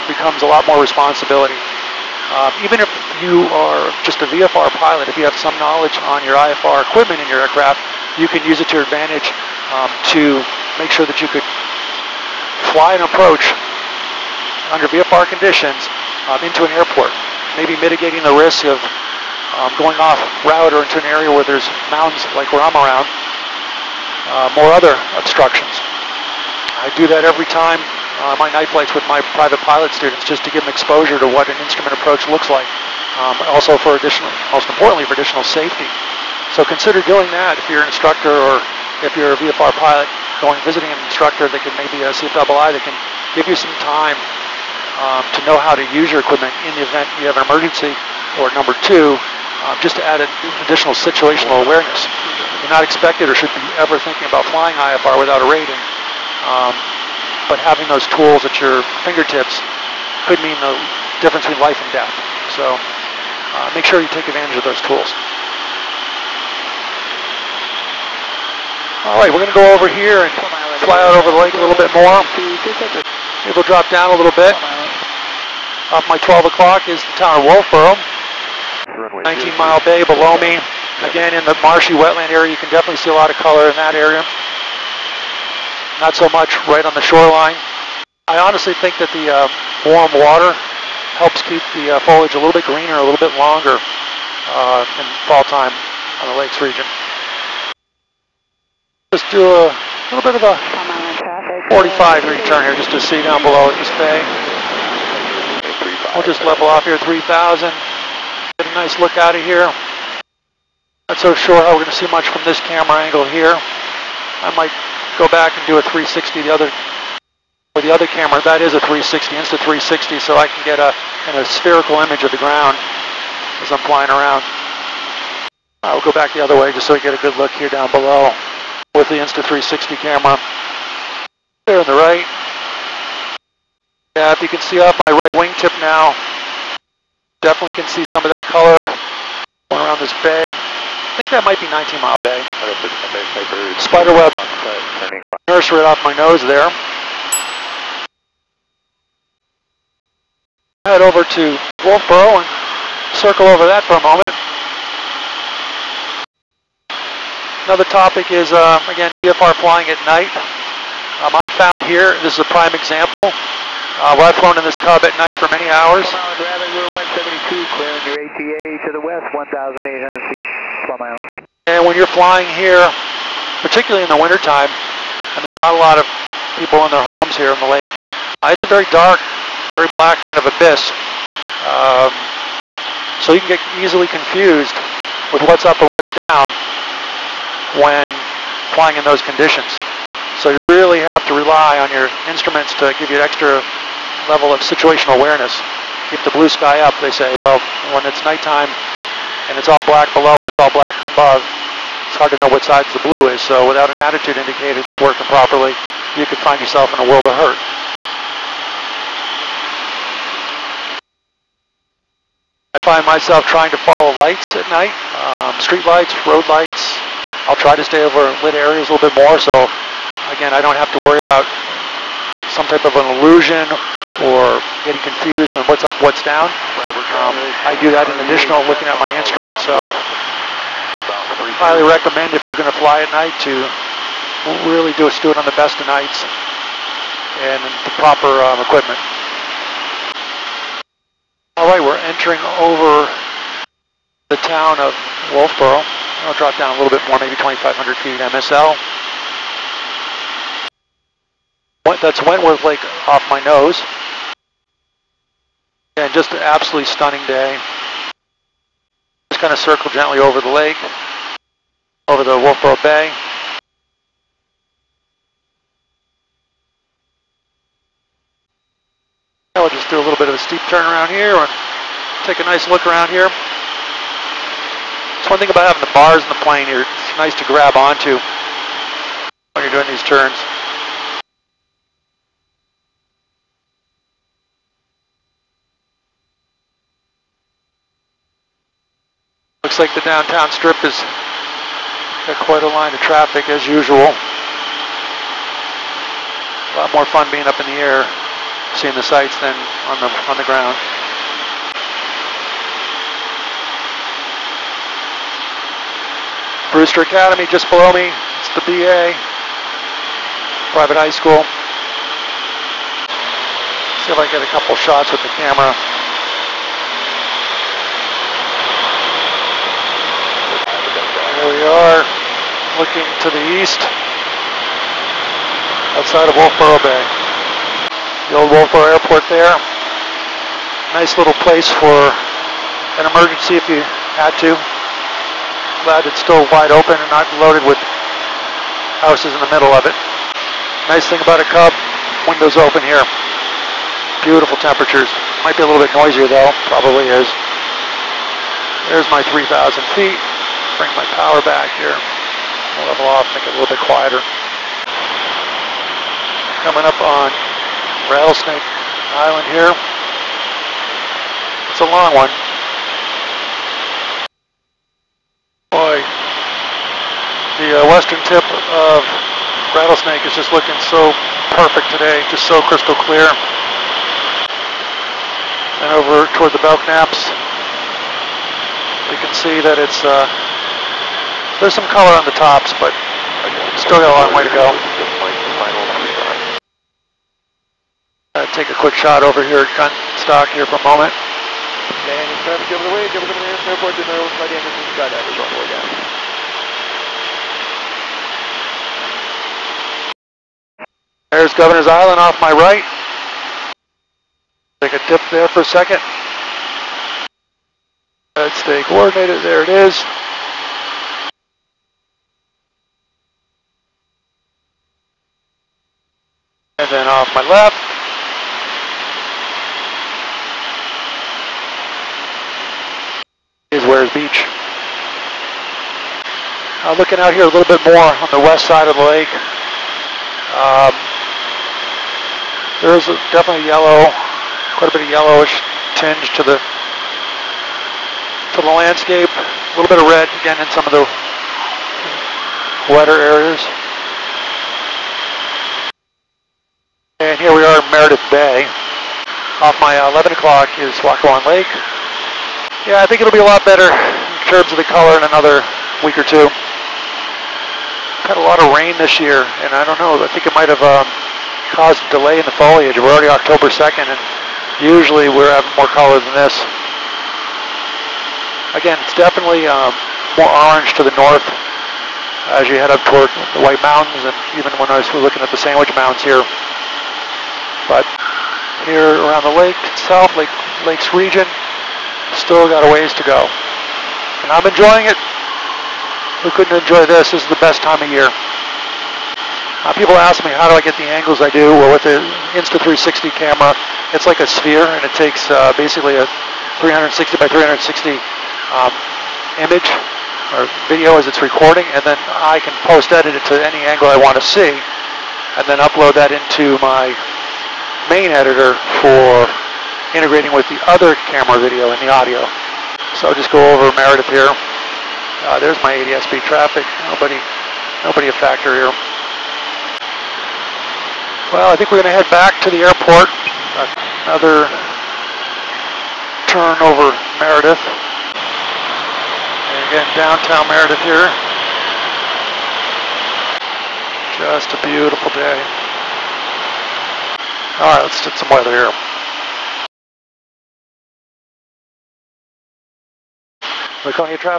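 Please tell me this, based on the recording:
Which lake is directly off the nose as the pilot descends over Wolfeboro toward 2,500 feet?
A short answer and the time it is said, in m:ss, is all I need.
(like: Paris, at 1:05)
Wentworth Lake, at 4:12.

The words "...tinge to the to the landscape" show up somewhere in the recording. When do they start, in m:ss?
7:15.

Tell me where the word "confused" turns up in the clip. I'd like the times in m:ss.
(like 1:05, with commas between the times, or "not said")
3:04, 3:44.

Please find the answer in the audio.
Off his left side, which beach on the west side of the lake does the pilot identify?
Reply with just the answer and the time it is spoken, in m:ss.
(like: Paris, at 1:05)
Weirs Beach, at 7:03.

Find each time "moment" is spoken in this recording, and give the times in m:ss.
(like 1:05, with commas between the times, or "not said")
2:34, 6:30.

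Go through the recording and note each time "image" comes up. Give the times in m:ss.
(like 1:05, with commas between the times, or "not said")
2:01, 8:19.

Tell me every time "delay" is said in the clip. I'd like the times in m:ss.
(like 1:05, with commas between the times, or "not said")
7:42.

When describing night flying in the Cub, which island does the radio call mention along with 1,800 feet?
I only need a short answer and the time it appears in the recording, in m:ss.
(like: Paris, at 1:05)
Plum Island, at 2:50.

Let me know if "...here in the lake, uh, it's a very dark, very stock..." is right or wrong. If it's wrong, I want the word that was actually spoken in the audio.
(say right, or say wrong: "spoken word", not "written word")
wrong: "black", not "stock".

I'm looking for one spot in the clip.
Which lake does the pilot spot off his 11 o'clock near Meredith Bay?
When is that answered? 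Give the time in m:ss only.
7:31.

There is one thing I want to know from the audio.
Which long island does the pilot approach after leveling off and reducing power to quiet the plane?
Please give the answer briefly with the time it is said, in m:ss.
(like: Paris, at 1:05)
Rattlesnake Island, at 5:58.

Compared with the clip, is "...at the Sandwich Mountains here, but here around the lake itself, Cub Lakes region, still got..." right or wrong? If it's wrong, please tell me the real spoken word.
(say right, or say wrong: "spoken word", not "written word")
wrong: "Lake", not "Cub".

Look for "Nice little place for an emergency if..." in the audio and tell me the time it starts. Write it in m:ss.
5:30.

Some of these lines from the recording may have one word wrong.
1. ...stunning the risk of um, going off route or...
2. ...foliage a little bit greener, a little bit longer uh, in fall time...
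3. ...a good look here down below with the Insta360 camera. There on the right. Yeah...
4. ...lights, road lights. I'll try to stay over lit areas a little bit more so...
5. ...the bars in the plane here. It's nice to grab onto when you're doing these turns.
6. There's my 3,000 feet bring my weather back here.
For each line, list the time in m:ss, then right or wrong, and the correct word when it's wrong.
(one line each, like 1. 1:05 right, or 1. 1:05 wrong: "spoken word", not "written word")
1. 0:17 wrong: "mitigating", not "stunning"
2. 1:32 right
3. 2:07 right
4. 3:35 right
5. 4:35 right
6. 5:48 wrong: "power", not "weather".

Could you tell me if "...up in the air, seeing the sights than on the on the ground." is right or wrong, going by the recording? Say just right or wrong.
right.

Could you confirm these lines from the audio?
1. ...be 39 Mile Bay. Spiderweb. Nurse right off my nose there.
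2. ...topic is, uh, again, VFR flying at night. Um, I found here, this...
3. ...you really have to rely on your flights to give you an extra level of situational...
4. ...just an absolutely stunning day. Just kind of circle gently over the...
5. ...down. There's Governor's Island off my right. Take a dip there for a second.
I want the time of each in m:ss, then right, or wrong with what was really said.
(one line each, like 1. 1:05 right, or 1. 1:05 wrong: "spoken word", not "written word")
1. 2:21 wrong: "19", not "39"
2. 2:37 right
3. 3:10 wrong: "instruments", not "flights"
4. 4:16 right
5. 6:35 right.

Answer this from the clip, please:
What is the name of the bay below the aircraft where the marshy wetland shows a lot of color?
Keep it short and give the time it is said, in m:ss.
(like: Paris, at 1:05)
19 Mile Bay, at 1:19.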